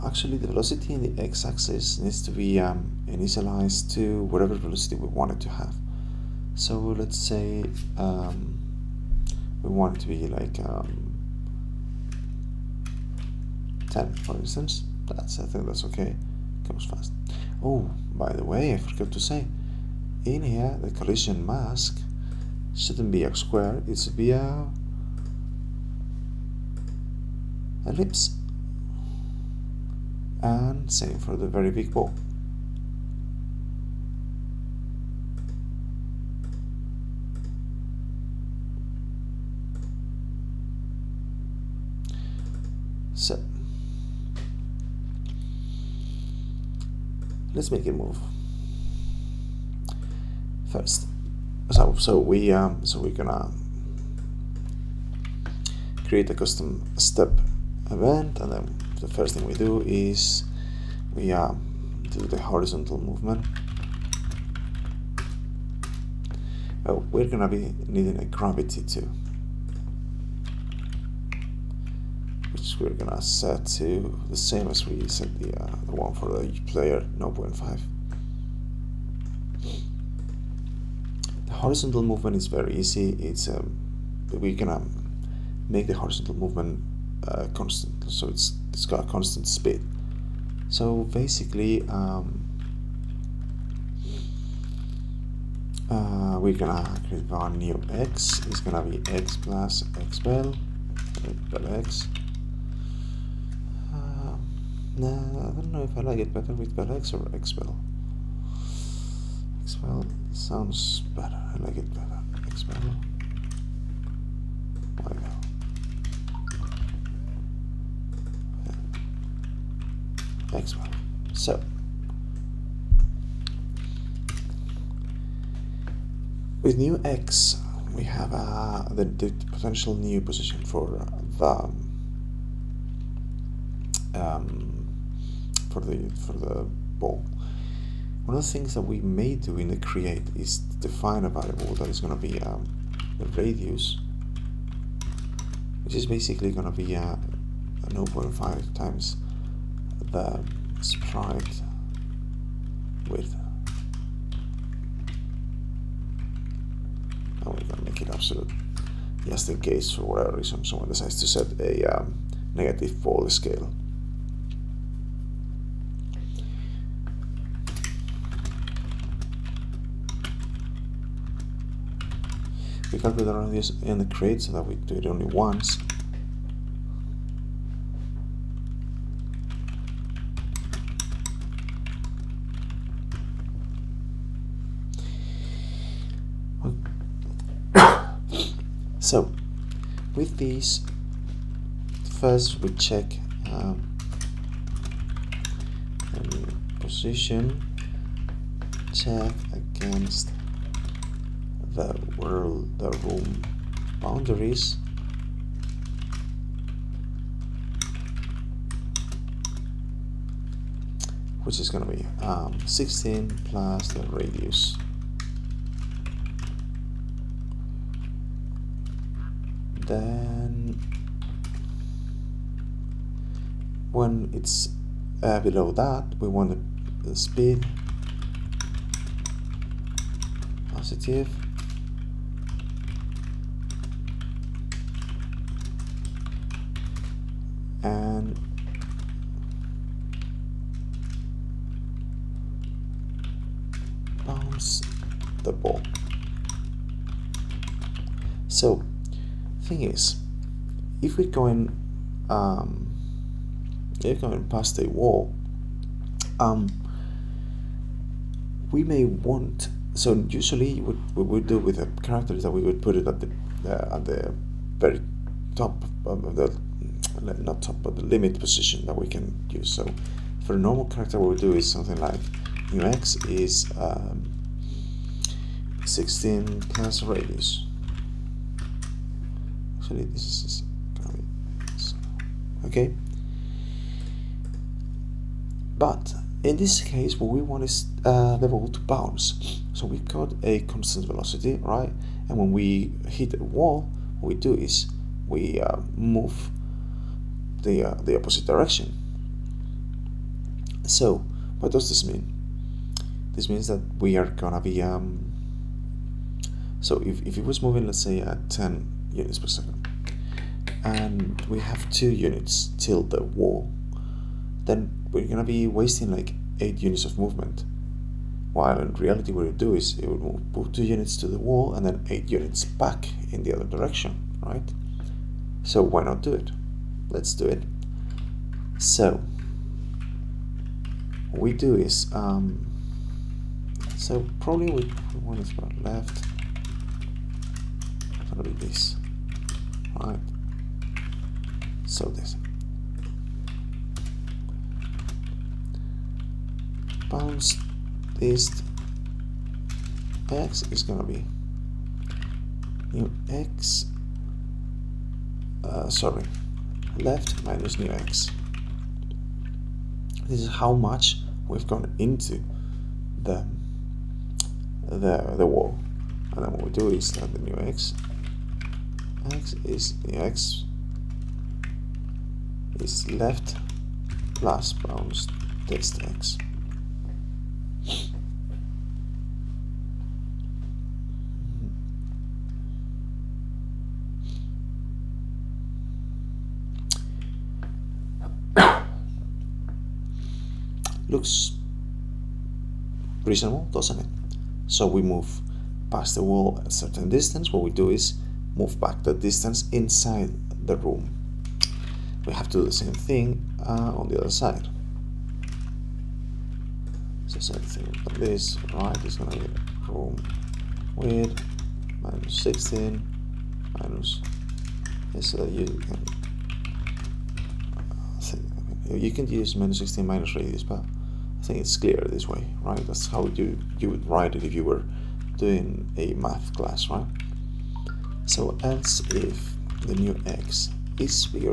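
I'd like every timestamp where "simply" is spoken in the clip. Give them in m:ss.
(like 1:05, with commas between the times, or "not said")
not said.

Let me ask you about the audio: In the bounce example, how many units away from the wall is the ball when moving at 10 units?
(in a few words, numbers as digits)
2.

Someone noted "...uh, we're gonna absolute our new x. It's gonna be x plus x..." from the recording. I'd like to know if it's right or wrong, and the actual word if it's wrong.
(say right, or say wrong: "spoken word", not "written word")
wrong: "create", not "absolute".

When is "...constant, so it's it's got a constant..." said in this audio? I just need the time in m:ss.
1:27.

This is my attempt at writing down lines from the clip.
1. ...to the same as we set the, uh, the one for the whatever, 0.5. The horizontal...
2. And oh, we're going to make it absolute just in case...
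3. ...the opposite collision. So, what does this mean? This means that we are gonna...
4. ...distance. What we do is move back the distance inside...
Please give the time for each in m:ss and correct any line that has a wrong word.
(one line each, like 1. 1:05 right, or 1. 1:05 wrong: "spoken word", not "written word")
1. 1:13 wrong: "player", not "whatever"
2. 2:37 right
3. 4:58 wrong: "direction", not "collision"
4. 6:37 right.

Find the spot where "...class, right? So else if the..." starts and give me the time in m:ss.
7:06.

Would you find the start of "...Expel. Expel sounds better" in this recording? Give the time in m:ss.
1:47.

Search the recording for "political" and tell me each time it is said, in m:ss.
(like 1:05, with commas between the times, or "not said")
not said.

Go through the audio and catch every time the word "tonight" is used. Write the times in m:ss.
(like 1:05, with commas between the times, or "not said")
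not said.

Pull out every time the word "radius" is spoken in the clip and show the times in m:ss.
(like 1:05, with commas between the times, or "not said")
2:23, 3:34, 4:37, 7:00.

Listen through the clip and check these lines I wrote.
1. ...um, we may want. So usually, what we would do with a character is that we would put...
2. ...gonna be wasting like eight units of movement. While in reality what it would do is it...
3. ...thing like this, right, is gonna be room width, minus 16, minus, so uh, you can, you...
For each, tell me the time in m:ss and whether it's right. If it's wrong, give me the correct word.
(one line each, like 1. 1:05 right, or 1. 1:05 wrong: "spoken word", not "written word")
1. 4:16 right
2. 5:15 right
3. 6:47 right.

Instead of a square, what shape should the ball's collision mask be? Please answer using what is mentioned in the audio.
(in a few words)
ellipse.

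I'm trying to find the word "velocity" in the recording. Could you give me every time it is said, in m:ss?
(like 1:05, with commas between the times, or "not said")
0:00, 0:04, 4:51.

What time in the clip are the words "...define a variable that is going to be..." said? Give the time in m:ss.
2:20.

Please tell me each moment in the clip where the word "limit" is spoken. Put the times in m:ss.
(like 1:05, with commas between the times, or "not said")
4:28.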